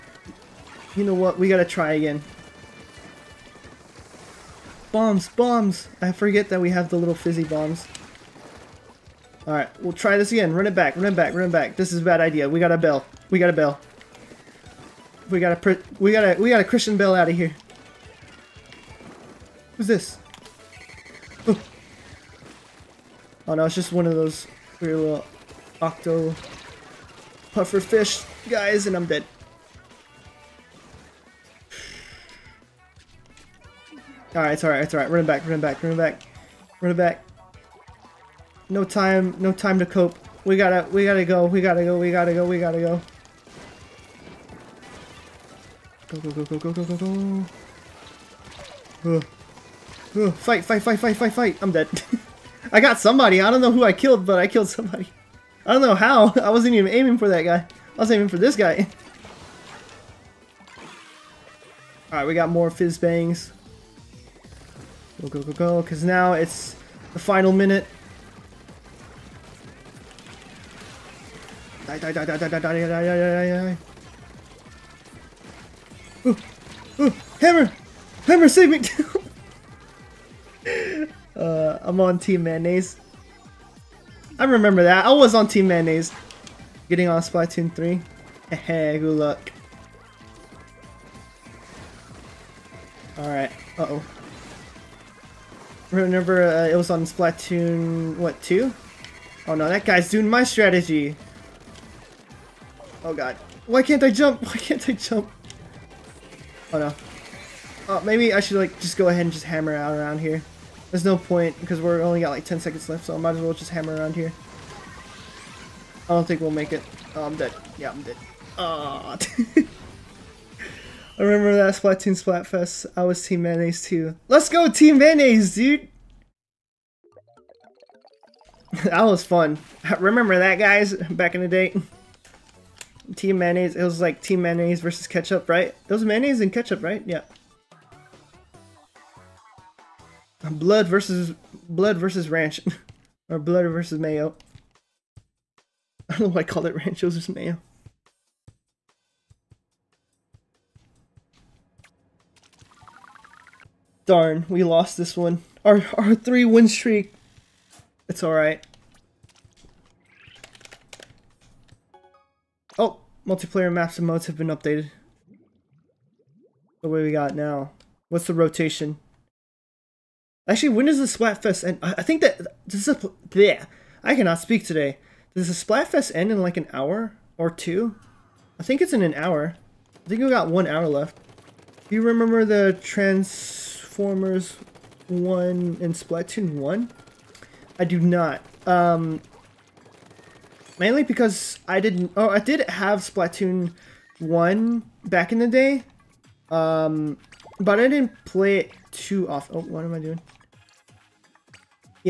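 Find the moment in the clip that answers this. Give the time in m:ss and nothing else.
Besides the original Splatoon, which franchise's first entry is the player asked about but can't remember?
3:02.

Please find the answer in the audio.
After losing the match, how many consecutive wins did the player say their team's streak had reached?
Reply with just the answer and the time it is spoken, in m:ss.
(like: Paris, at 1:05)
3, at 2:36.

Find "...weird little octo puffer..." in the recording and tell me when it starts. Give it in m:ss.
0:24.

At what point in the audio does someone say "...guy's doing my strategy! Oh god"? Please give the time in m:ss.
1:39.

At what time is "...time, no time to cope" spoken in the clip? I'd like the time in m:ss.
0:38.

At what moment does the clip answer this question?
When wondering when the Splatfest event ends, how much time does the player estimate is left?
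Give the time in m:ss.
3:00.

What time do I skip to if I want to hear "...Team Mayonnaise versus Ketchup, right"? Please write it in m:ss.
2:14.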